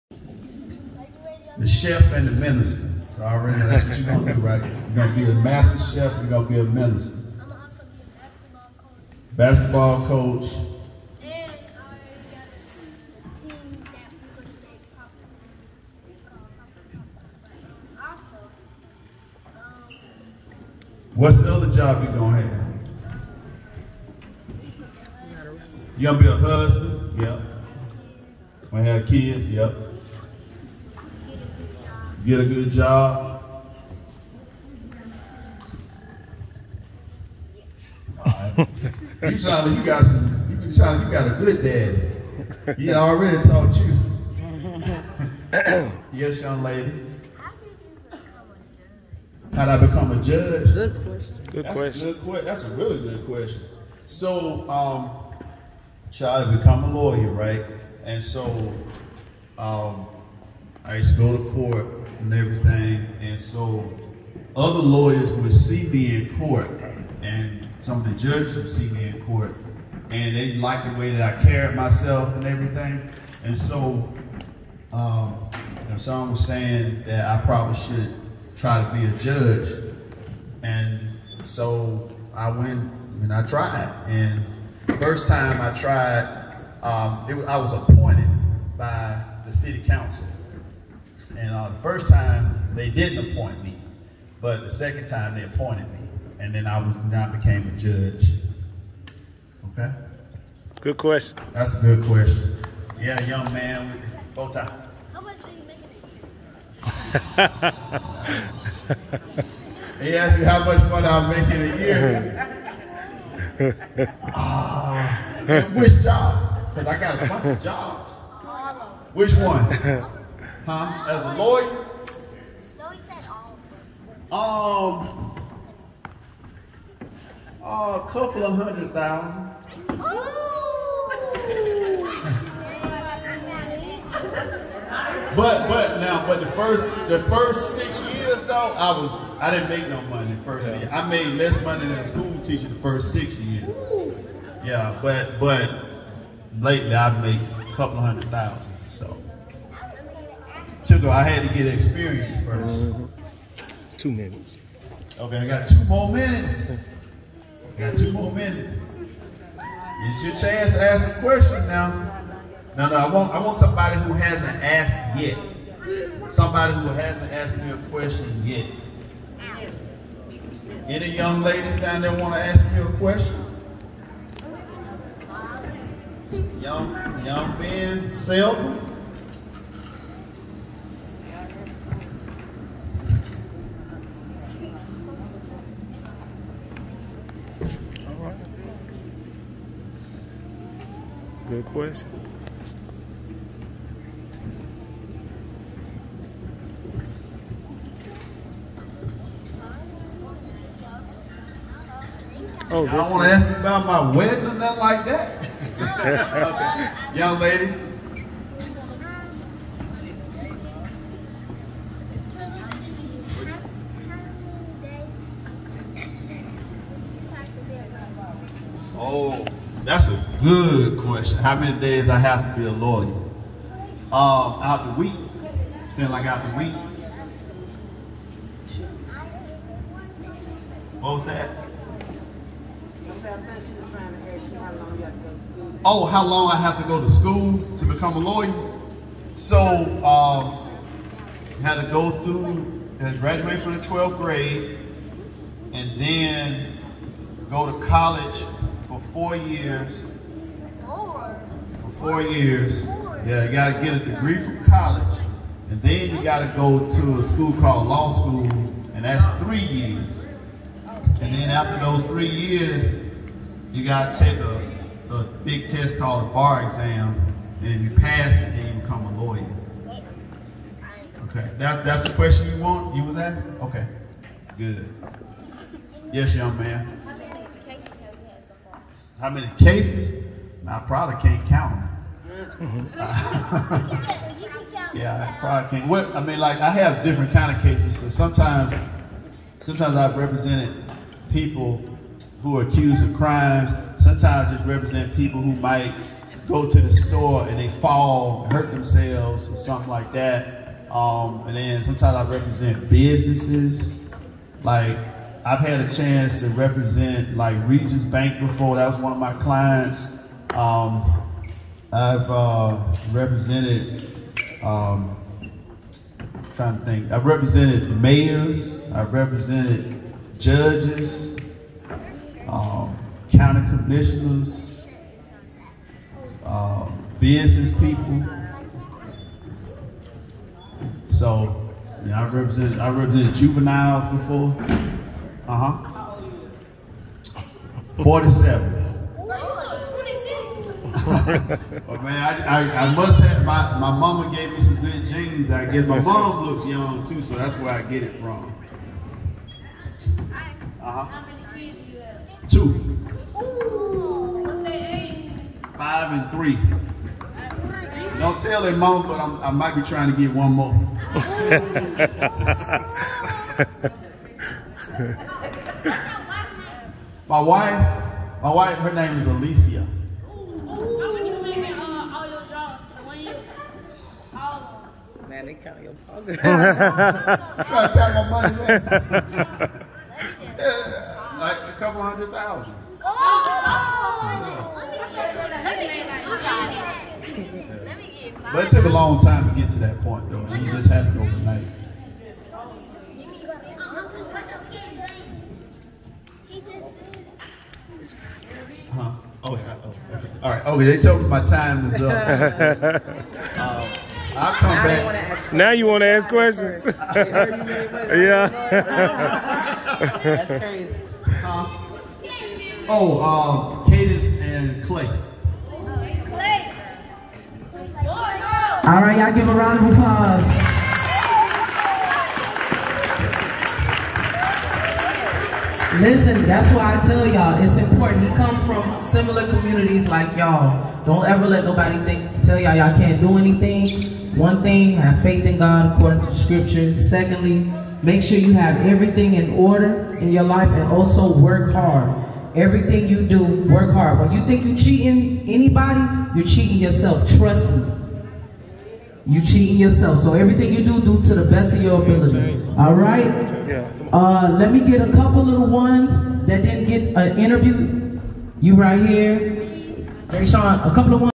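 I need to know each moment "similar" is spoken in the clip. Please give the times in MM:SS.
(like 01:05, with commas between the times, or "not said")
07:08.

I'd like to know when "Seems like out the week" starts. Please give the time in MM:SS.
03:45.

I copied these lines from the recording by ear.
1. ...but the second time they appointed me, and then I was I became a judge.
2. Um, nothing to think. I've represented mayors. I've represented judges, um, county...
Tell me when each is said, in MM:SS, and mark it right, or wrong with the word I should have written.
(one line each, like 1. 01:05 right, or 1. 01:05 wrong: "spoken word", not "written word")
1. 01:34 right
2. 05:14 wrong: "trying", not "nothing".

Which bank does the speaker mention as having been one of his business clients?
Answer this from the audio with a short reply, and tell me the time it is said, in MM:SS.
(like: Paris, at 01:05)
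Regions Bank, at 05:07.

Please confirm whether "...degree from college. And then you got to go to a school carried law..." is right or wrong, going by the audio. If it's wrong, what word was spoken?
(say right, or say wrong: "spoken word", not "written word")
wrong: "called", not "carried".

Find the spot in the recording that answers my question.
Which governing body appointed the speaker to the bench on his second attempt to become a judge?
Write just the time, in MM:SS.
01:29.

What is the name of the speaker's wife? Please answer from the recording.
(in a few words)
Alicia.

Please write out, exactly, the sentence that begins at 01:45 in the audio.
How much are you making a year?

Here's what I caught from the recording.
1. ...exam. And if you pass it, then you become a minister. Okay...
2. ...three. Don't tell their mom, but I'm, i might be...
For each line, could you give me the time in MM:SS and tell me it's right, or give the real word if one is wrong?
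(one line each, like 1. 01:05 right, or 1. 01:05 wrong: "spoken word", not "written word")
1. 04:26 wrong: "lawyer", not "minister"
2. 05:56 right.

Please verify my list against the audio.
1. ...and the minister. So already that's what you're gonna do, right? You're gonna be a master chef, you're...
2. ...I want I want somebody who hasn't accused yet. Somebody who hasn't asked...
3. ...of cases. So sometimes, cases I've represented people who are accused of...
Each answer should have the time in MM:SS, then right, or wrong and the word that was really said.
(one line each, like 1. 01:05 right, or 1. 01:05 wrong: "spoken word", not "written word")
1. 00:02 right
2. 02:42 wrong: "asked", not "accused"
3. 04:47 wrong: "sometimes", not "cases".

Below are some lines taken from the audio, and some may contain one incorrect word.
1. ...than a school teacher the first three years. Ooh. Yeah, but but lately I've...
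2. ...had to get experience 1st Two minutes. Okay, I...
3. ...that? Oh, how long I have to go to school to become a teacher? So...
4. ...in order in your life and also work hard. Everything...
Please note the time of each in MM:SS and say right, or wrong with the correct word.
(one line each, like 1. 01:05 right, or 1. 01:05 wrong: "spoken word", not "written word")
1. 02:21 wrong: "six", not "three"
2. 02:31 right
3. 03:51 wrong: "lawyer", not "teacher"
4. 07:19 right.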